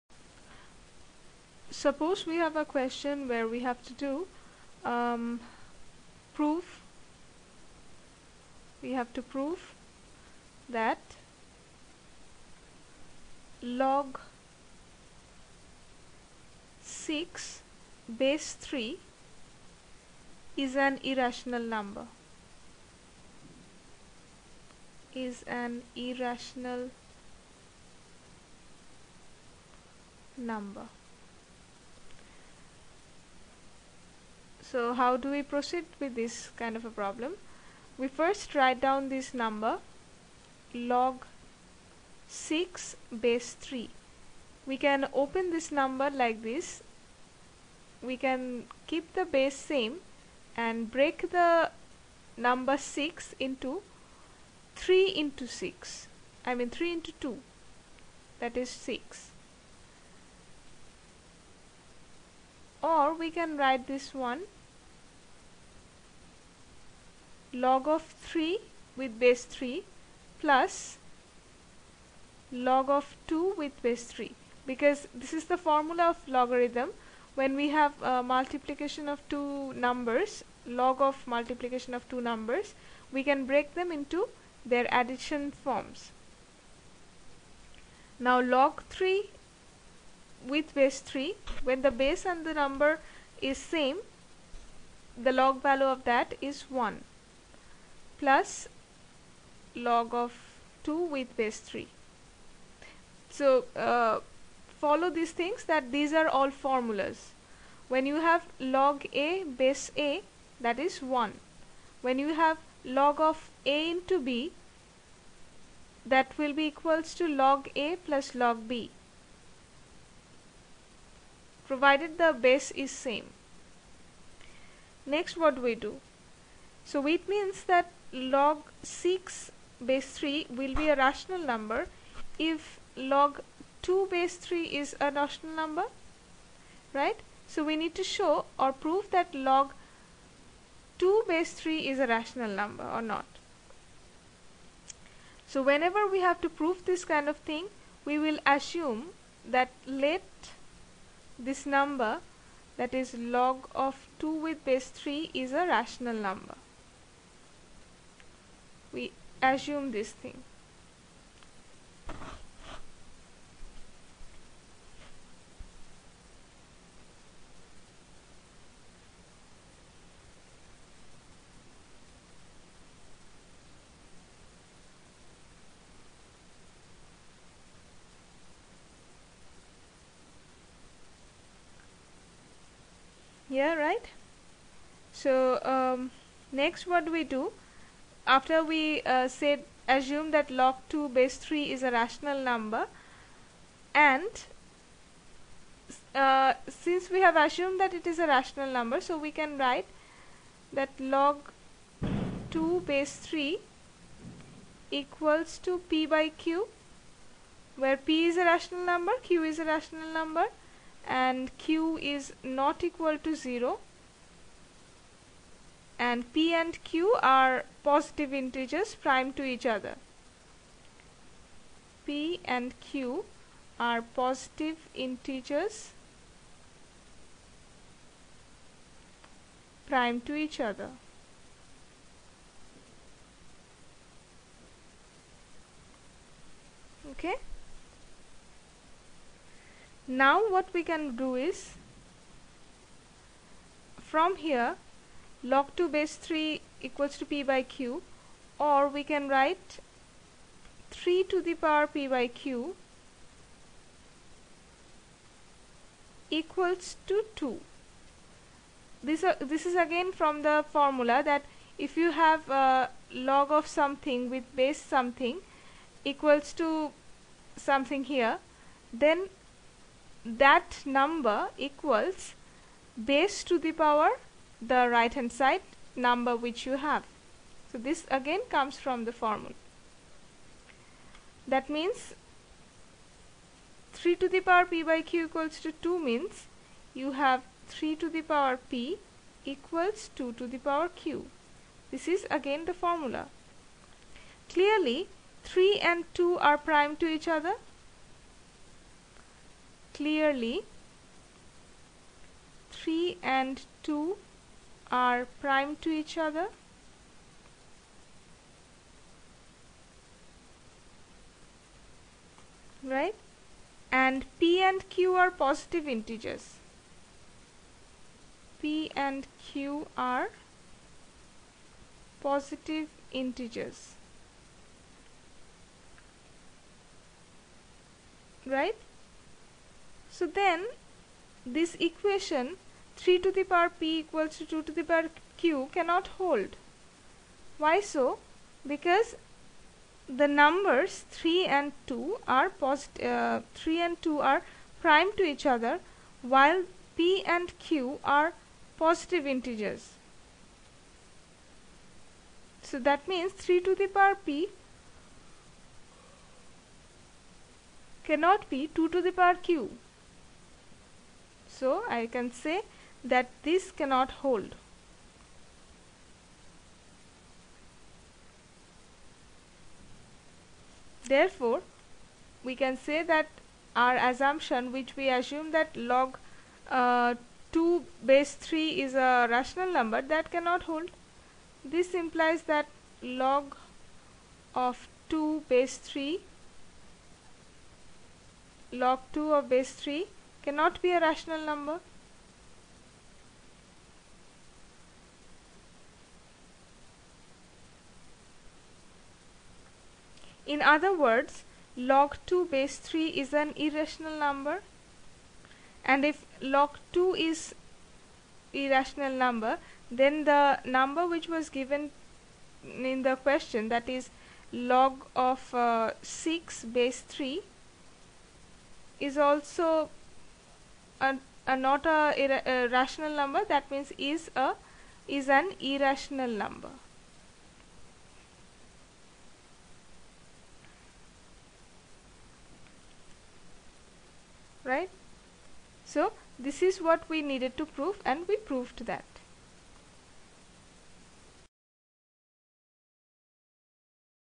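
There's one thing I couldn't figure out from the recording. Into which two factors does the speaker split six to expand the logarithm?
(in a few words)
3 into 2.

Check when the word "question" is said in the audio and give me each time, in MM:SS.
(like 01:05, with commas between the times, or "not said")
00:02, 06:53.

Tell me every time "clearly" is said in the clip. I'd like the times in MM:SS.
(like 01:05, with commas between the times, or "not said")
04:54, 04:59.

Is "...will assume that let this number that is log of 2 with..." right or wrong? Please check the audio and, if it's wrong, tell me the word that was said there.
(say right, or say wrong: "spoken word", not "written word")
right.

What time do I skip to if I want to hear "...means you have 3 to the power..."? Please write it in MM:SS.
04:46.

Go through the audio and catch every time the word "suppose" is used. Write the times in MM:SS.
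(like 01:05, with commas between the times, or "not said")
00:01.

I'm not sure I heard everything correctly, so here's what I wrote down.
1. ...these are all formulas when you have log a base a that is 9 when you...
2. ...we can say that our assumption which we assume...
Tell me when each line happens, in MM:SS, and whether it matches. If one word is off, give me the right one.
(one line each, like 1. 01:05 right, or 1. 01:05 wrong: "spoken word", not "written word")
1. 01:45 wrong: "1", not "9"
2. 06:12 right.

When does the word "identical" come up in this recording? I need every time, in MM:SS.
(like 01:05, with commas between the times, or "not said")
not said.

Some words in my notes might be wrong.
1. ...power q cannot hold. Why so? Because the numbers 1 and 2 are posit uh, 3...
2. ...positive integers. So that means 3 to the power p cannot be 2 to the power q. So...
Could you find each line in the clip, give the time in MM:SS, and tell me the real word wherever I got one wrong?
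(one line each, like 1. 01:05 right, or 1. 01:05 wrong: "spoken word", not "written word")
1. 05:34 wrong: "3", not "1"
2. 05:48 right.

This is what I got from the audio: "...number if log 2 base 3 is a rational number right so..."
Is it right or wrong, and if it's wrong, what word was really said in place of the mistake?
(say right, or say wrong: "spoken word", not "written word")
right.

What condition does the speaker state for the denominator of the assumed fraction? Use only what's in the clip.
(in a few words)
q is not equal to 0.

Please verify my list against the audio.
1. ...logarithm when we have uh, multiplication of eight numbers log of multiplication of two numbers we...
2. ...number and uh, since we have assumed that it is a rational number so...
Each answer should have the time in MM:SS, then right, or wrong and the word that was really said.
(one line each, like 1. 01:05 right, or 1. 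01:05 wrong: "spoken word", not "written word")
1. 01:16 wrong: "two", not "eight"
2. 03:12 right.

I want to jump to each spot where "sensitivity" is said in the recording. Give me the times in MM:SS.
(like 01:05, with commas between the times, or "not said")
not said.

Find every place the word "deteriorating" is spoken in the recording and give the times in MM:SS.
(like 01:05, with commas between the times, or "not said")
not said.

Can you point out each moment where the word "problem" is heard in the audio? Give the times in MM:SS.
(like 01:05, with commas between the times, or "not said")
00:36.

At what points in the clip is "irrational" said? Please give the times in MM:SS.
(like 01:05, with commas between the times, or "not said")
00:21, 00:25, 06:43, 06:48, 07:05.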